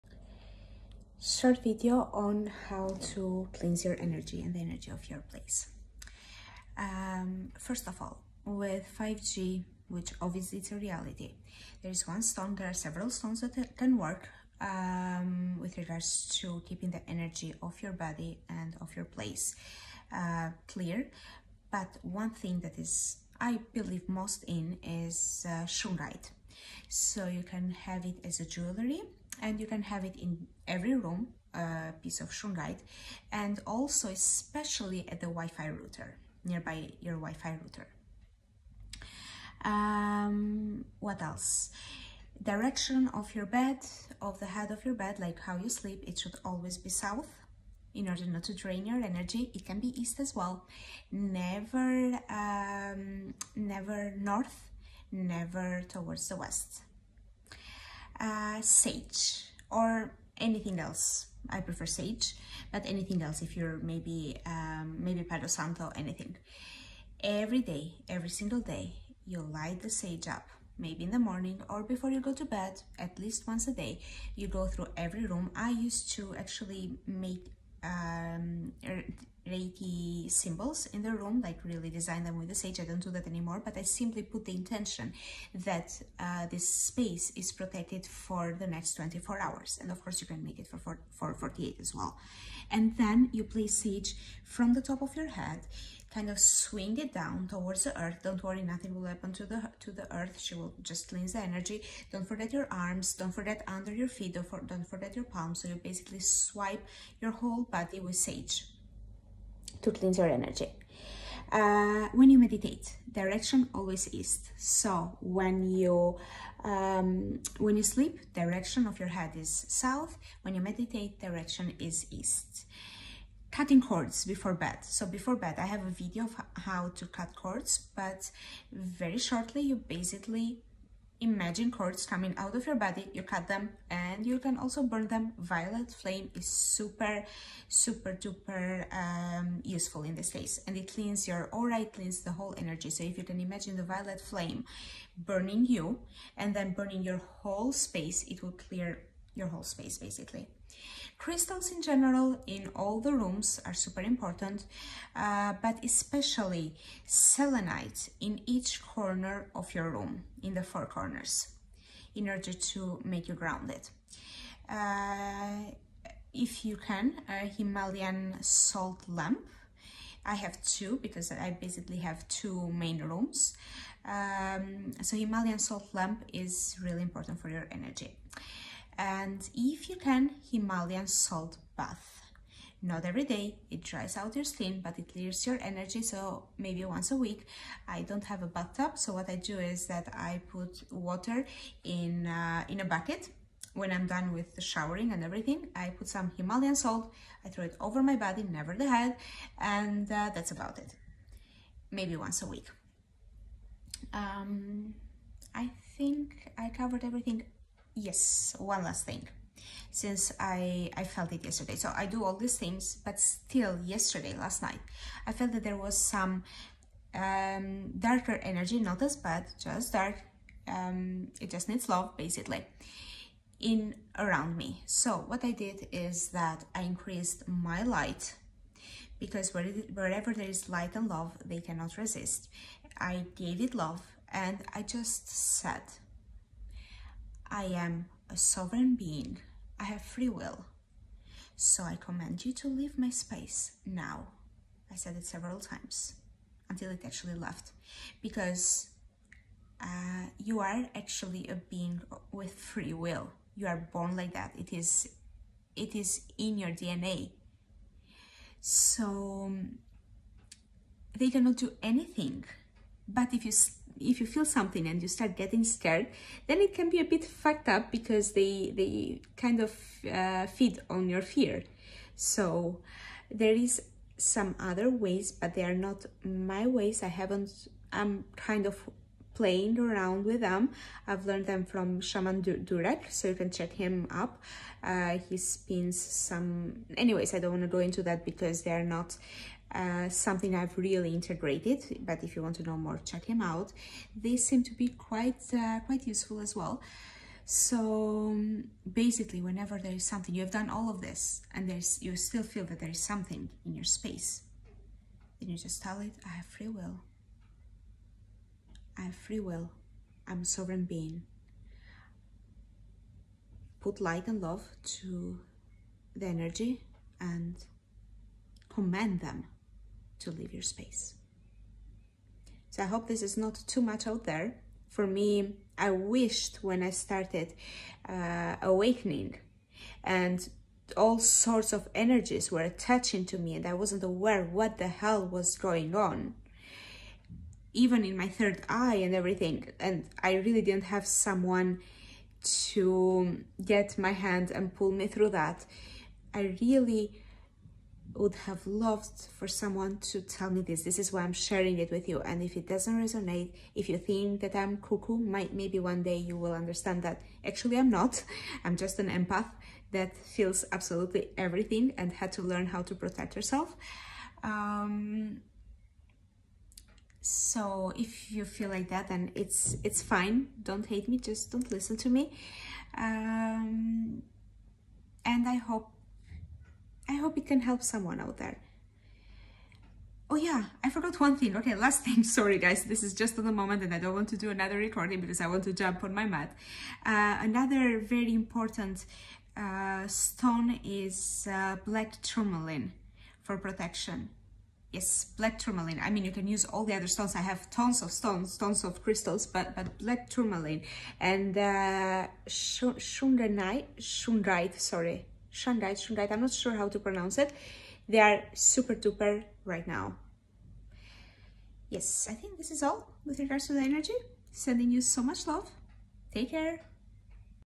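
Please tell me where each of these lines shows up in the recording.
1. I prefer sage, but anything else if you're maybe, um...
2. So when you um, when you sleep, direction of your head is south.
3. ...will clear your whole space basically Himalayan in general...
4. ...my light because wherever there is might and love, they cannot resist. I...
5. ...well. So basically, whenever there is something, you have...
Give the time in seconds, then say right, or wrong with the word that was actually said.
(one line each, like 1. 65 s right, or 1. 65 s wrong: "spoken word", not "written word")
1. 61 s right
2. 114 s right
3. 148 s wrong: "Crystals", not "Himalayan"
4. 227 s wrong: "light", not "might"
5. 296 s right.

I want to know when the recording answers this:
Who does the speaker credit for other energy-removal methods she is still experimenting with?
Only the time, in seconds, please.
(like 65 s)
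281 s.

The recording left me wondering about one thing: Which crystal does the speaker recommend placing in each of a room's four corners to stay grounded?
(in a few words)
Selenite.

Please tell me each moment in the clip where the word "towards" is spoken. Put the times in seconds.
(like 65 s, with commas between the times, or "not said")
55 s, 97 s.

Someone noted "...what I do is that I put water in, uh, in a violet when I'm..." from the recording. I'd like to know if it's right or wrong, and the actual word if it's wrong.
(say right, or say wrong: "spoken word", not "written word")
wrong: "bucket", not "violet".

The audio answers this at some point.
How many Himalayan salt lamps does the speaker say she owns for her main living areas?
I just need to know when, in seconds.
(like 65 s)
170 s.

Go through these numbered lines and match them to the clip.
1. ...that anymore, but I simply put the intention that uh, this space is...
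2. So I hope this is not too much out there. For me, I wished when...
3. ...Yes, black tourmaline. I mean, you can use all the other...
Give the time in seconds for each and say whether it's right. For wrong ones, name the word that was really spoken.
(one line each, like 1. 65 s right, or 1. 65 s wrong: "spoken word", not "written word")
1. 83 s right
2. 322 s right
3. 394 s right.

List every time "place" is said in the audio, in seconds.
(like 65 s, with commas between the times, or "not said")
5 s, 19 s, 93 s.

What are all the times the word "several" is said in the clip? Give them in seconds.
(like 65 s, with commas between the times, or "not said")
12 s, 245 s.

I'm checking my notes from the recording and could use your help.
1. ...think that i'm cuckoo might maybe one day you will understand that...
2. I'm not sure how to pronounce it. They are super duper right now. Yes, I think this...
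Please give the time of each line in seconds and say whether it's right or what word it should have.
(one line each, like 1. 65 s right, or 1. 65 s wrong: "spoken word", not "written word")
1. 353 s right
2. 406 s right.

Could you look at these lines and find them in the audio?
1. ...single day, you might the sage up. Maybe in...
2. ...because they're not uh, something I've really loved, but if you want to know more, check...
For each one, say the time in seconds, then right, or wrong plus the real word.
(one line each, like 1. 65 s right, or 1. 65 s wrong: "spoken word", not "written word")
1. 68 s wrong: "light", not "might"
2. 288 s wrong: "integrated", not "loved".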